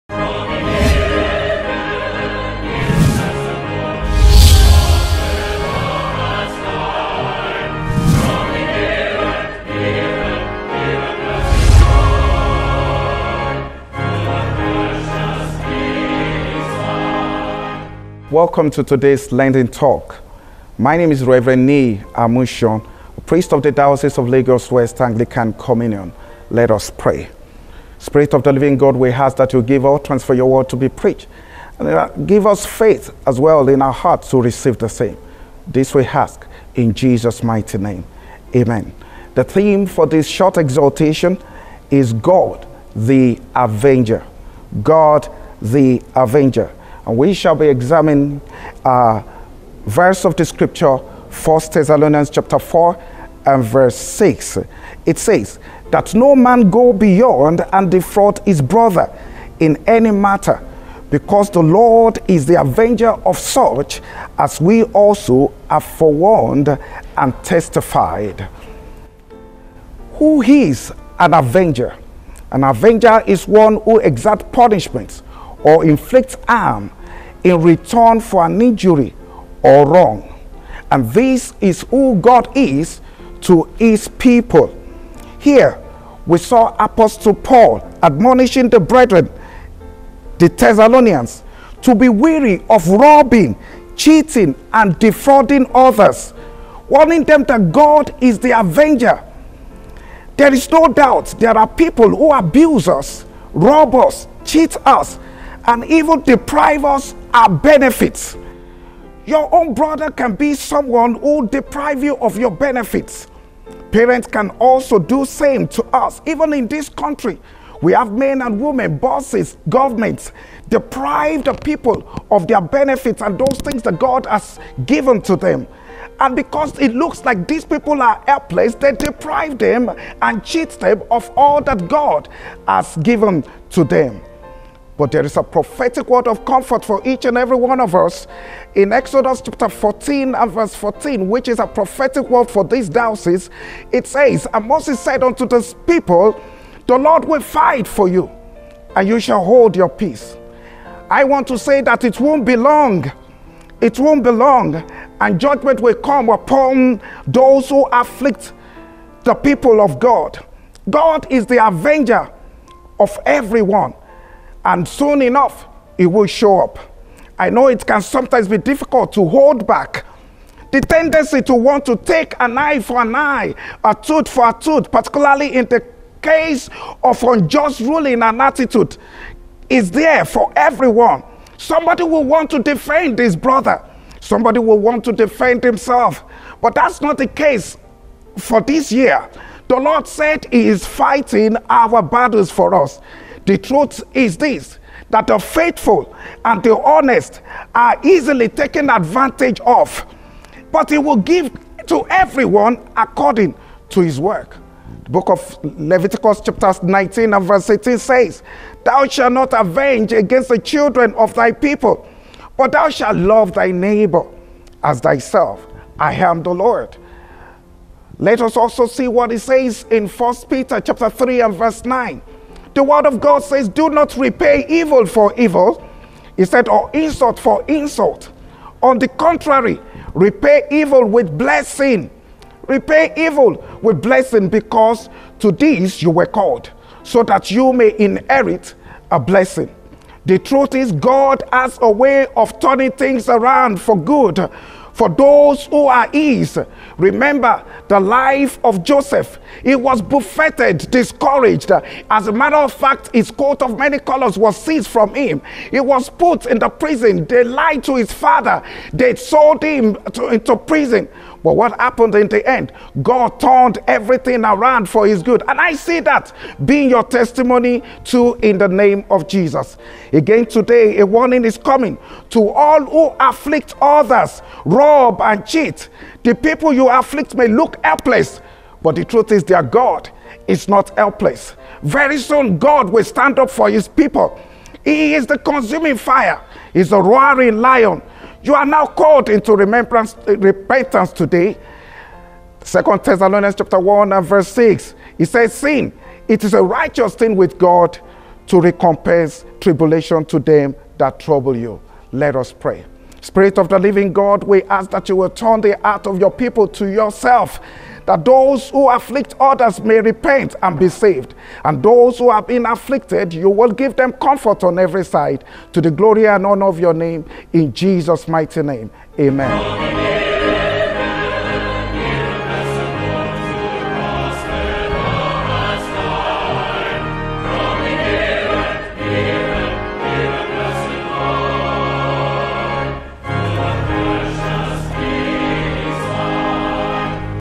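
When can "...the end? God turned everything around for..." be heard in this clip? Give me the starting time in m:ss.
4:22.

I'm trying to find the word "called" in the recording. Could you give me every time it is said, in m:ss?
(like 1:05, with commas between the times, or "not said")
3:56, 4:48.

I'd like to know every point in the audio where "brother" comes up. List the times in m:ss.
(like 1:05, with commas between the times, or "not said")
0:58, 1:49, 3:03.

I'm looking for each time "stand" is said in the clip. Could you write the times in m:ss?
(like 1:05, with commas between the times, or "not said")
4:43.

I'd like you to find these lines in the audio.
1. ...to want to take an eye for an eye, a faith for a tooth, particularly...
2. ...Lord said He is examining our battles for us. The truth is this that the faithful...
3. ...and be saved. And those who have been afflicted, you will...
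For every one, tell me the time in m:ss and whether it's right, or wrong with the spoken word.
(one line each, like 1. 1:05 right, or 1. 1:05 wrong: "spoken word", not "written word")
1. 2:51 wrong: "tooth", not "faith"
2. 3:09 wrong: "fighting", not "examining"
3. 5:10 right.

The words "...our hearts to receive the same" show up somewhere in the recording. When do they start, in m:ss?
0:33.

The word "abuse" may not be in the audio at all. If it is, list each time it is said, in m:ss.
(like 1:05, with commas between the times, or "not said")
1:42.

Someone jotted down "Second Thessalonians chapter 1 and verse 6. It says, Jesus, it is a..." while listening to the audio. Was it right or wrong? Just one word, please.
wrong.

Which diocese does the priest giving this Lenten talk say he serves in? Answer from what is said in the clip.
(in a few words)
Lagos West.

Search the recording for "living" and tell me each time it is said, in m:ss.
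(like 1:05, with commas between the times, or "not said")
0:28, 5:03.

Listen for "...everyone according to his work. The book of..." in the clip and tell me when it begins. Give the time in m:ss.
3:22.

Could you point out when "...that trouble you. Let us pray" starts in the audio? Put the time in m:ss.
5:00.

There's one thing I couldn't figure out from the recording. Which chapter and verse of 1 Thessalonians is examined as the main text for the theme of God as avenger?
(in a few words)
Chapter 4, verse 6.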